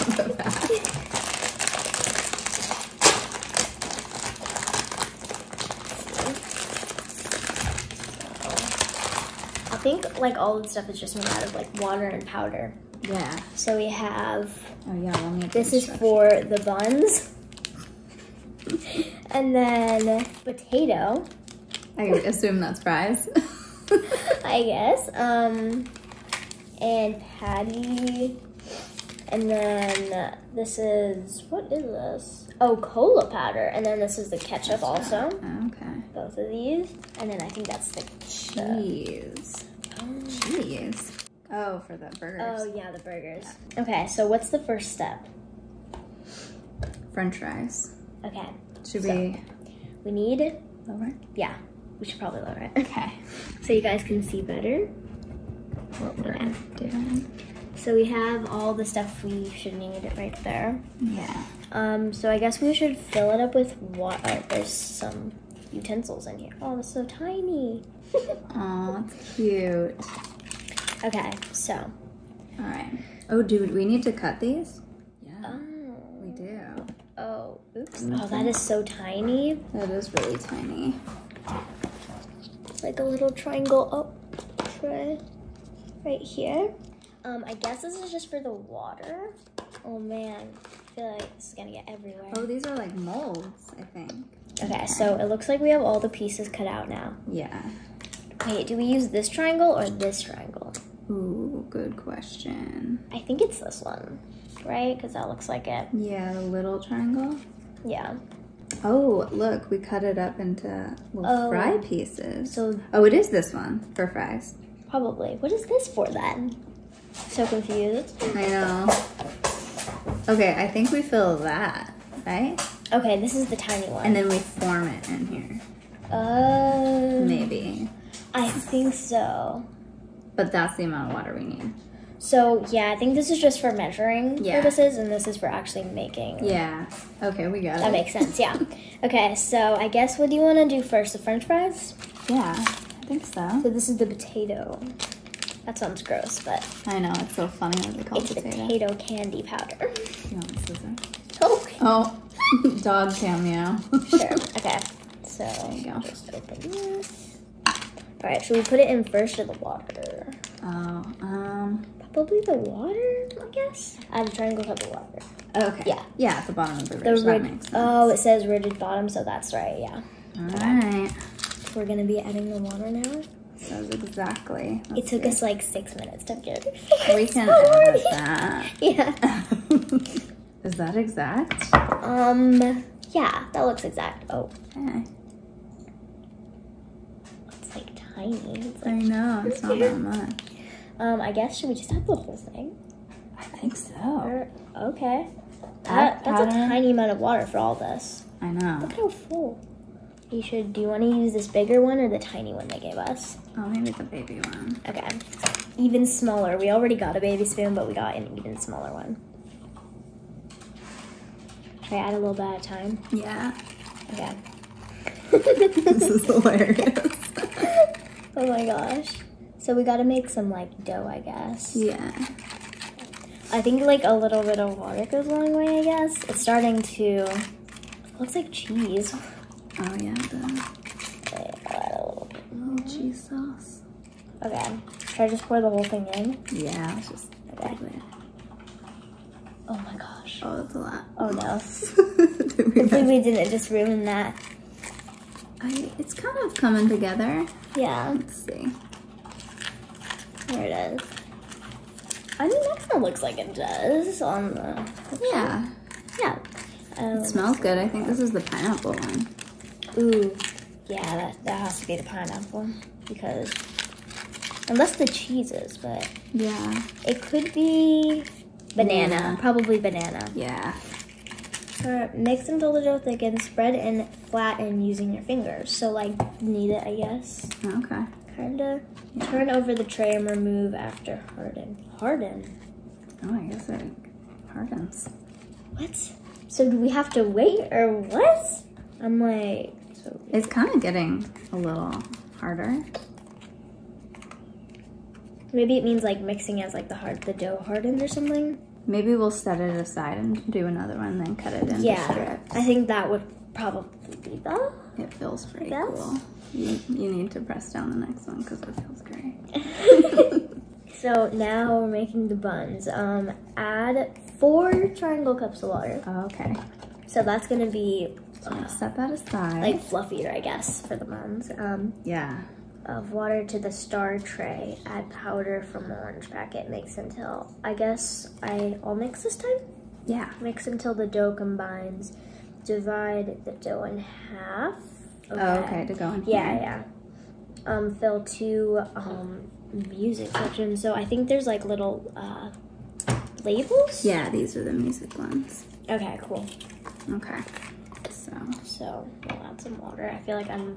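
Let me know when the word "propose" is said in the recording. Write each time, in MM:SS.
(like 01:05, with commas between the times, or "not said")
not said.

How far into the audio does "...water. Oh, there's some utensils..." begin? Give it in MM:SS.
01:03.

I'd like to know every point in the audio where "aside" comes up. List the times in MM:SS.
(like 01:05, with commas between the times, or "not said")
04:59, 05:19.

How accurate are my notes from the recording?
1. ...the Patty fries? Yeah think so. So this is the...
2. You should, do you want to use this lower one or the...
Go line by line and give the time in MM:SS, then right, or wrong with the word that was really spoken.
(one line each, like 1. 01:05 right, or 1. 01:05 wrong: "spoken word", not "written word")
1. 02:21 wrong: "French", not "Patty"
2. 03:20 wrong: "bigger", not "lower".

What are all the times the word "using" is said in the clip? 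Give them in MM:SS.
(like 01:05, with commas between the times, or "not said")
04:34.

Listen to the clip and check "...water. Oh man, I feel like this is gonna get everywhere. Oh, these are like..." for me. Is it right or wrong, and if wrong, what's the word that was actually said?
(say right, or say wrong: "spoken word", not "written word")
right.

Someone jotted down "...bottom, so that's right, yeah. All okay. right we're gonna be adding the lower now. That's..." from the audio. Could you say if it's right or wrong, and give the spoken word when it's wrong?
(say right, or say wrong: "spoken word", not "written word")
wrong: "water", not "lower".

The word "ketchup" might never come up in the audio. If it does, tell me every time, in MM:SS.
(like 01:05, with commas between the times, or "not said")
00:34.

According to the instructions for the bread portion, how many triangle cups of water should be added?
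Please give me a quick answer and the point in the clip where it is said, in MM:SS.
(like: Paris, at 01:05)
4, at 05:14.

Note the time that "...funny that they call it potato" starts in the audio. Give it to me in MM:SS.
02:27.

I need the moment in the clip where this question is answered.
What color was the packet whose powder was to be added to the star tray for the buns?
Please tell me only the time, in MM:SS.
05:25.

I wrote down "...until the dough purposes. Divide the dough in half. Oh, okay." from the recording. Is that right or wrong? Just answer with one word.
wrong.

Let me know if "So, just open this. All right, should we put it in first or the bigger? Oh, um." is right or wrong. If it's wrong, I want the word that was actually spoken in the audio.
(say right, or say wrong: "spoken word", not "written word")
wrong: "water", not "bigger".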